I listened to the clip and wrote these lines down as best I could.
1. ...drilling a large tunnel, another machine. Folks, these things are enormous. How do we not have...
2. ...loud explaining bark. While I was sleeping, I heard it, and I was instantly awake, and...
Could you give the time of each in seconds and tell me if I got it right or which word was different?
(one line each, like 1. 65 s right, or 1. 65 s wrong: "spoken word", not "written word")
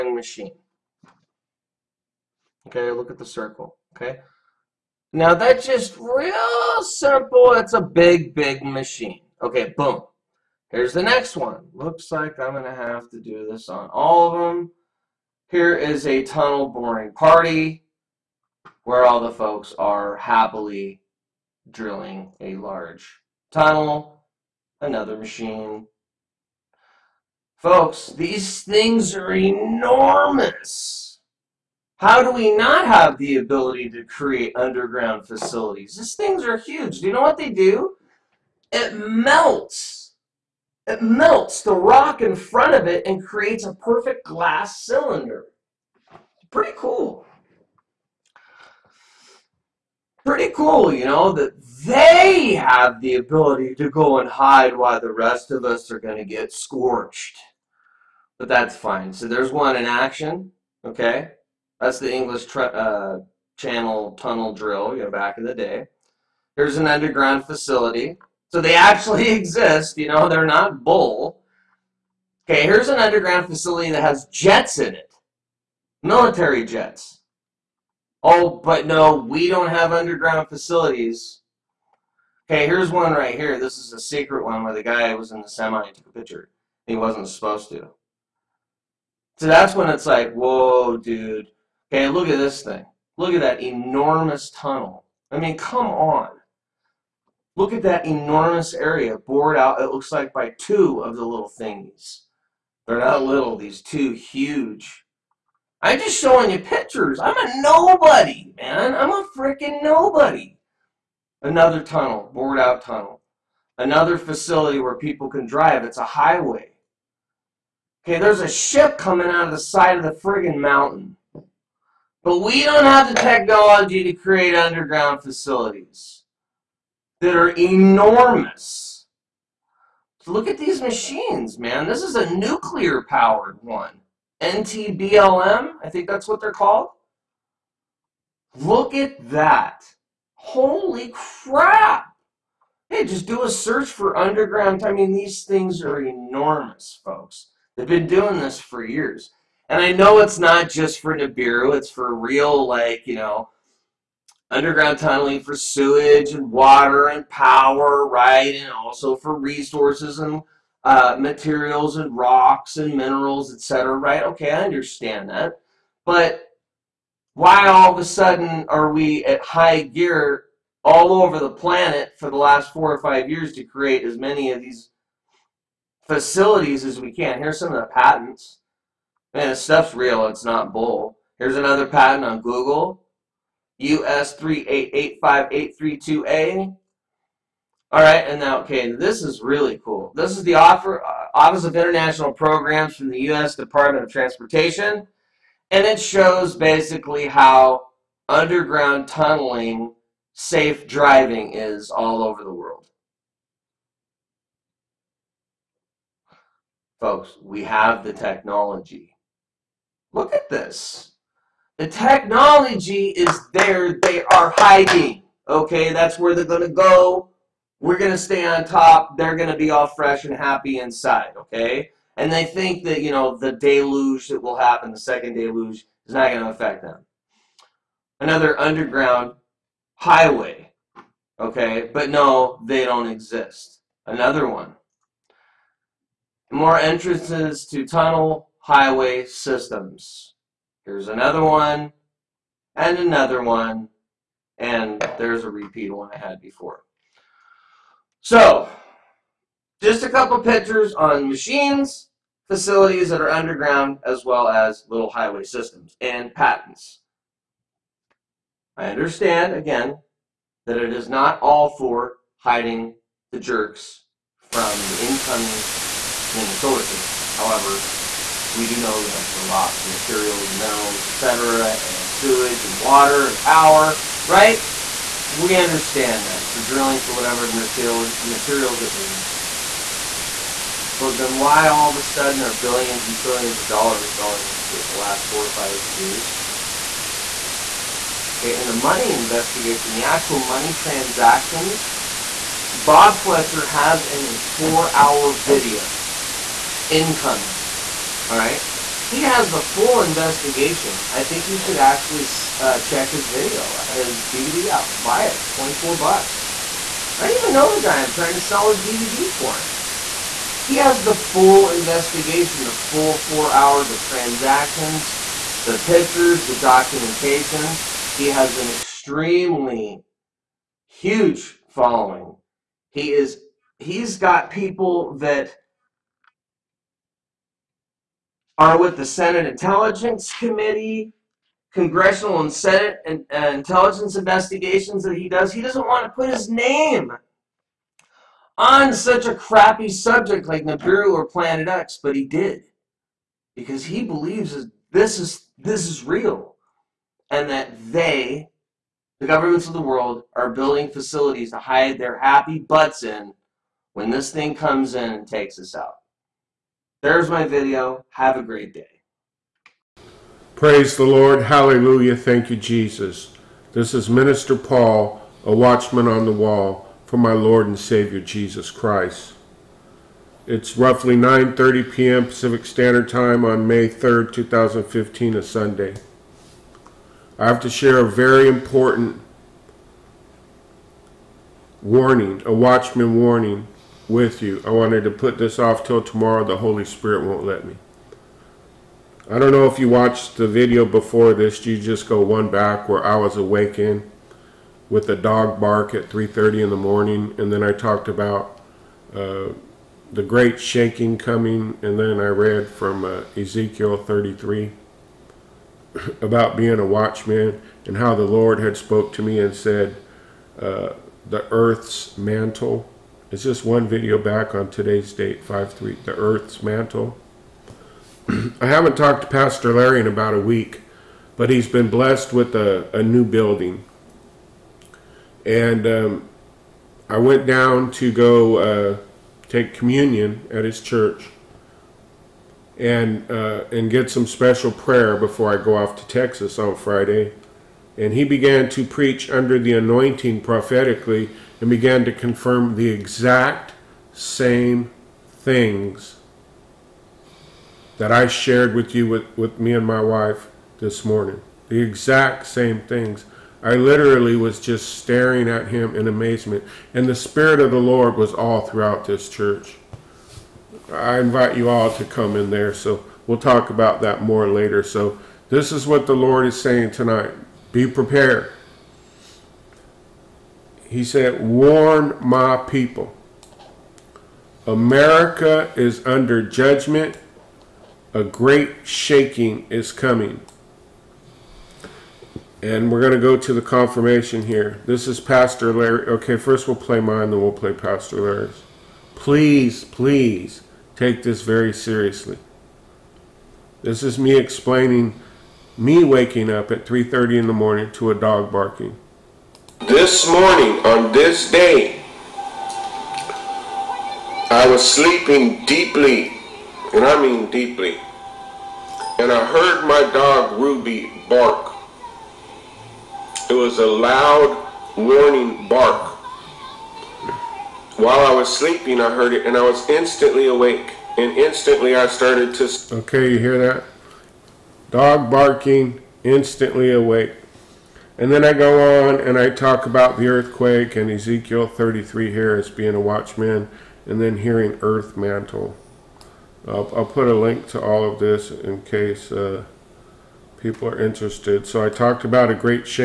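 1. 21 s right
2. 513 s wrong: "warning", not "explaining".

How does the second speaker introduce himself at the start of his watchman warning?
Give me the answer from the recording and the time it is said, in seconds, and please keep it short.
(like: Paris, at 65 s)
Minister Paul, at 364 s.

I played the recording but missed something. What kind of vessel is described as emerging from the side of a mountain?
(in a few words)
ship.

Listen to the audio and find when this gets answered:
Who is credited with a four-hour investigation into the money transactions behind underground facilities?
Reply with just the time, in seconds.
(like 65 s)
292 s.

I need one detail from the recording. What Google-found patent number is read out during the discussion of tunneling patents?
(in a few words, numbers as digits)
US 3885832A.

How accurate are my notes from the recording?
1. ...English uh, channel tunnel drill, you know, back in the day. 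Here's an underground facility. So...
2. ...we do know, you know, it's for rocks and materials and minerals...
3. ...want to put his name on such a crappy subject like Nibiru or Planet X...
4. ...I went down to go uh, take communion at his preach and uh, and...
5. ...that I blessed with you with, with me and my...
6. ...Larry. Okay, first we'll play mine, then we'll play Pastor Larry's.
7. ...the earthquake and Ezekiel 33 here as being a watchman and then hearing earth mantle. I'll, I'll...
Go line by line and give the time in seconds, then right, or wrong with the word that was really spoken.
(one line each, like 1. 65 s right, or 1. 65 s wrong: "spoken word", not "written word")
1. 62 s right
2. 268 s right
3. 335 s right
4. 427 s wrong: "church", not "preach"
5. 447 s wrong: "shared", not "blessed"
6. 485 s right
7. 530 s right.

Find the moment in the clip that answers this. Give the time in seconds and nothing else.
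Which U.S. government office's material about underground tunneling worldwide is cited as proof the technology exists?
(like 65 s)
191 s.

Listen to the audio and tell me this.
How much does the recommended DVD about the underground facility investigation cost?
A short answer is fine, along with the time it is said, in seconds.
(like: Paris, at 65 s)
24 bucks, at 305 s.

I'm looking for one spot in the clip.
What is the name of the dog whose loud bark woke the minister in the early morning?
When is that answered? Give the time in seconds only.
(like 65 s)
510 s.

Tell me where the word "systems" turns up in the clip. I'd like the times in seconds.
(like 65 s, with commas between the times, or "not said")
239 s, 255 s, 266 s.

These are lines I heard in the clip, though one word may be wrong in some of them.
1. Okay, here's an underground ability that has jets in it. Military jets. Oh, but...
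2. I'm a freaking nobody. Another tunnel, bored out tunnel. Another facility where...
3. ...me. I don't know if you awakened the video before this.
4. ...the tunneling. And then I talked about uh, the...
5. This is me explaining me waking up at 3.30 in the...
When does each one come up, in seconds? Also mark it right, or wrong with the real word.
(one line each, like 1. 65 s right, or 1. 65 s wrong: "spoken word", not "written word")
1. 72 s wrong: "facility", not "ability"
2. 108 s right
3. 387 s wrong: "watched", not "awakened"
4. 396 s wrong: "morning", not "tunneling"
5. 493 s right.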